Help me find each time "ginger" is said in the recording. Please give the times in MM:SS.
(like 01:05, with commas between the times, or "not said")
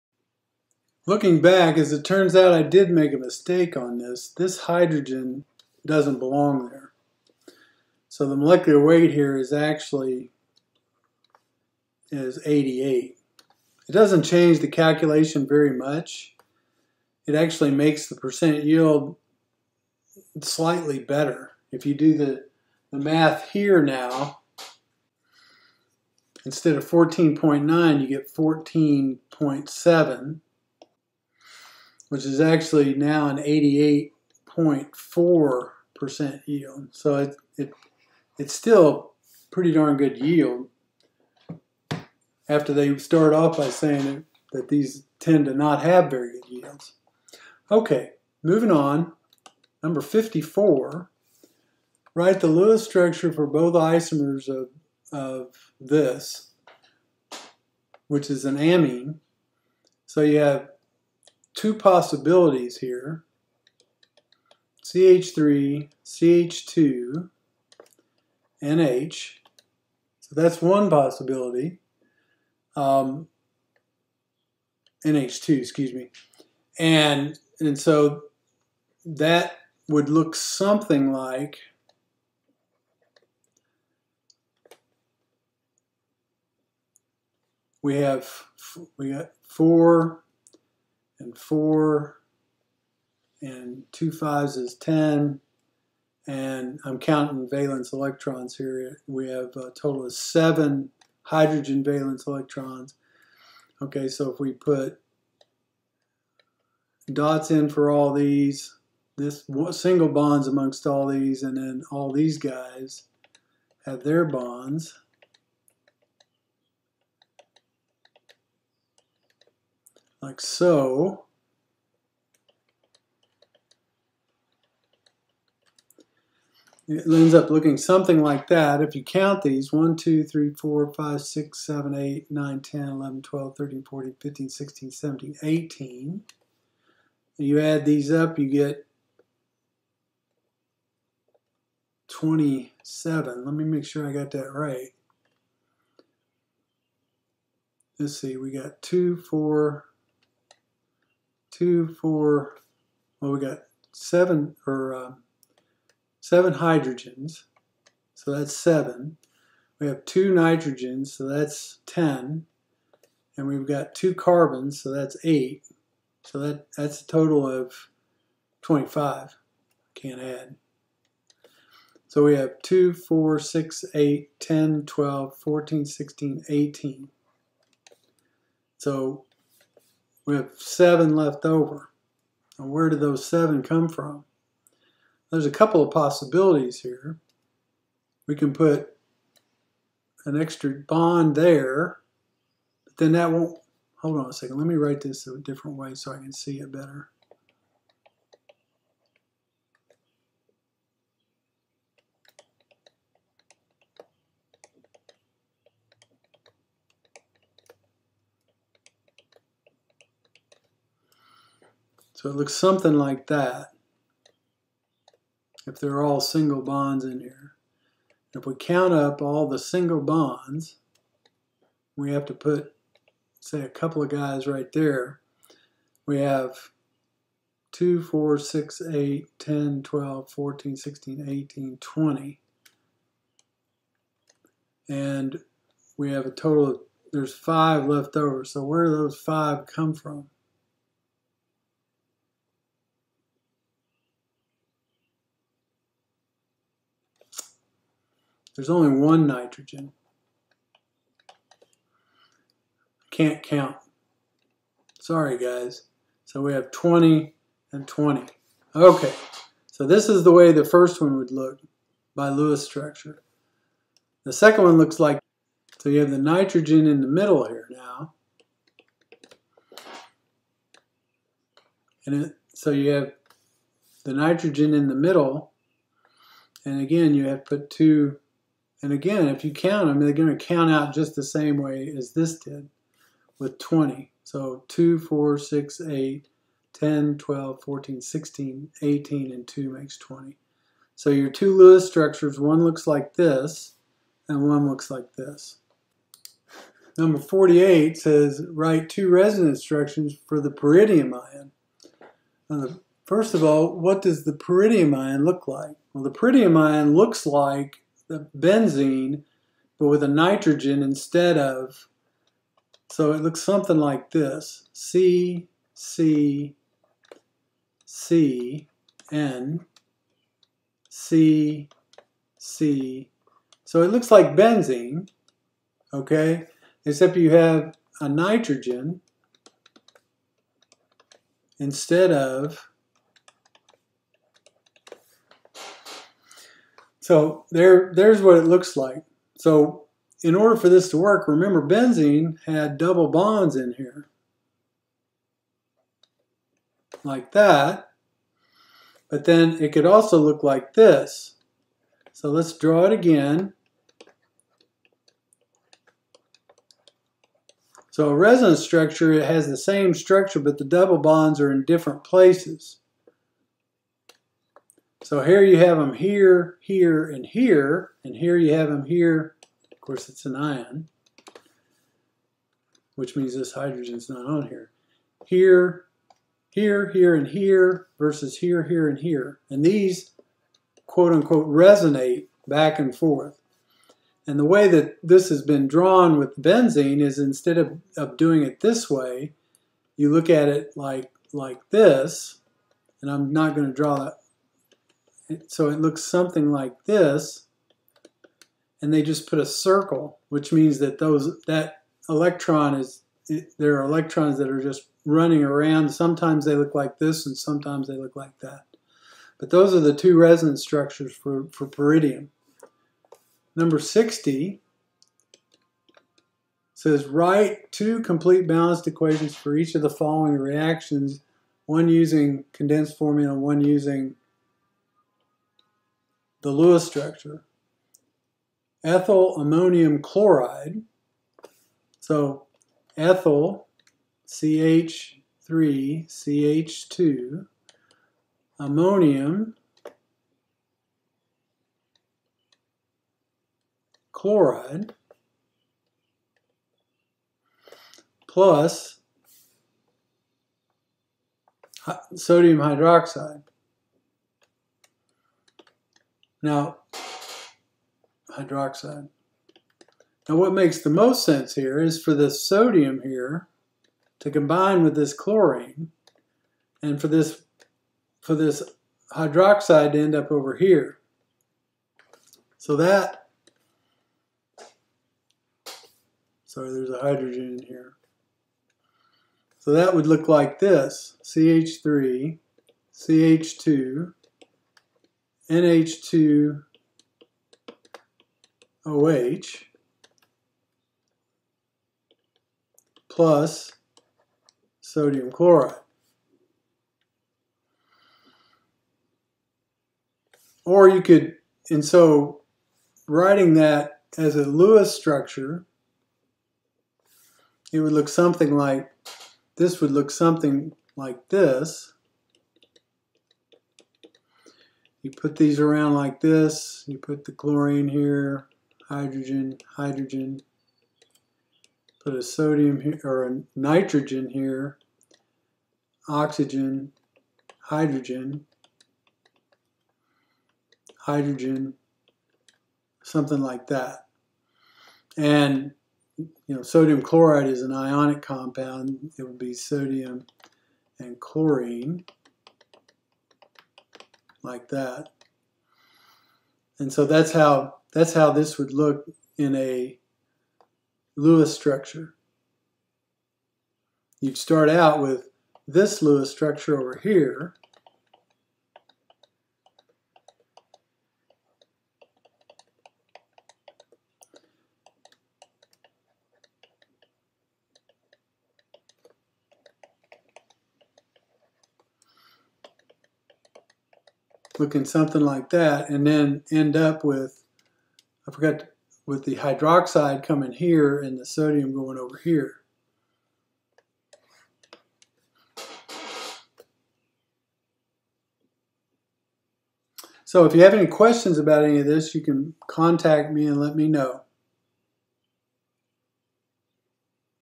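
not said.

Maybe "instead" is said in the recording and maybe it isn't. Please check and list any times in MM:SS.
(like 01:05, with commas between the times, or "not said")
00:26, 05:10, 05:31, 06:27.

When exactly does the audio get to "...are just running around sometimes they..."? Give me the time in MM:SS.
06:44.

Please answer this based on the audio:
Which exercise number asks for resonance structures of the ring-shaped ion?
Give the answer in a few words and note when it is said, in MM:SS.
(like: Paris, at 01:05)
48, at 04:56.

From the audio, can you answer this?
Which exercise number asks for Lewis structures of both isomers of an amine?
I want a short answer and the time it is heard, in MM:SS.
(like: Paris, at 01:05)
54, at 00:49.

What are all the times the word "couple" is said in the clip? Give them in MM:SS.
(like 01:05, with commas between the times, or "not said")
03:05, 03:43.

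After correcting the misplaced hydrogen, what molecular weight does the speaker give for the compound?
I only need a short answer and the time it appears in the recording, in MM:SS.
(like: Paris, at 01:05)
88, at 00:12.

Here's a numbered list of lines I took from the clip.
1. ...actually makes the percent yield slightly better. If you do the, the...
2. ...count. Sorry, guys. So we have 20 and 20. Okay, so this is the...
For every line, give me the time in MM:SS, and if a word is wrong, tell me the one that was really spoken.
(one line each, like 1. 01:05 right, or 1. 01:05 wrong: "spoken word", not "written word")
1. 00:17 right
2. 04:13 right.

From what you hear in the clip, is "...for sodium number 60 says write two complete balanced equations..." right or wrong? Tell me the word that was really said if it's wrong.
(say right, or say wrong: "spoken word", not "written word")
wrong: "pyridinium", not "sodium".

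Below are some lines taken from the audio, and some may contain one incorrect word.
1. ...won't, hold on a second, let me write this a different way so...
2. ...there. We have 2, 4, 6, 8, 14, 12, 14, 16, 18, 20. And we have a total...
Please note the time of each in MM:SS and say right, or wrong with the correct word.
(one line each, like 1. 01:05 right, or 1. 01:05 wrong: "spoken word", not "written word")
1. 03:13 right
2. 03:44 wrong: "10", not "14".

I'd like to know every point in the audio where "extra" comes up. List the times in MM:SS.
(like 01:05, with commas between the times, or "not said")
03:10.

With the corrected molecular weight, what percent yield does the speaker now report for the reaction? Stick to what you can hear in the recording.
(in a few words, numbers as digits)
88.4%.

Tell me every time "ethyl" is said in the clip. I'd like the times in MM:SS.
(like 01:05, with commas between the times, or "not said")
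07:08, 07:12.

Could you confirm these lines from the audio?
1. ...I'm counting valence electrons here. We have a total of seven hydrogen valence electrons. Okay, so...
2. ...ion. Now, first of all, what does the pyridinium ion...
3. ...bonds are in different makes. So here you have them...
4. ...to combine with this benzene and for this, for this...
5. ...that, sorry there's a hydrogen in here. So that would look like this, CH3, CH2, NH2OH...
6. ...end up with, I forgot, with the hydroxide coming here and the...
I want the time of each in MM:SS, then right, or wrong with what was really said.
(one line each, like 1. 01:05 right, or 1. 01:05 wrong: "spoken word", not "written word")
1. 01:36 right
2. 05:01 right
3. 06:00 wrong: "places", not "makes"
4. 07:44 wrong: "chlorine", not "benzene"
5. 07:52 right
6. 09:36 right.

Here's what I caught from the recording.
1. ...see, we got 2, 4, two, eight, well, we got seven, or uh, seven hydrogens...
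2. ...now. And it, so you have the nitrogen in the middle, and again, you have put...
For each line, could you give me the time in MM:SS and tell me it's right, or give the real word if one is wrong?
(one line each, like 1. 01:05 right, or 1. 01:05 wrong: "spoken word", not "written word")
1. 02:28 wrong: "four", not "eight"
2. 04:27 right.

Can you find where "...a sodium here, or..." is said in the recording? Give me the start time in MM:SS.
08:42.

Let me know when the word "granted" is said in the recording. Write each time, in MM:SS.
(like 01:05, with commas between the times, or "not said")
not said.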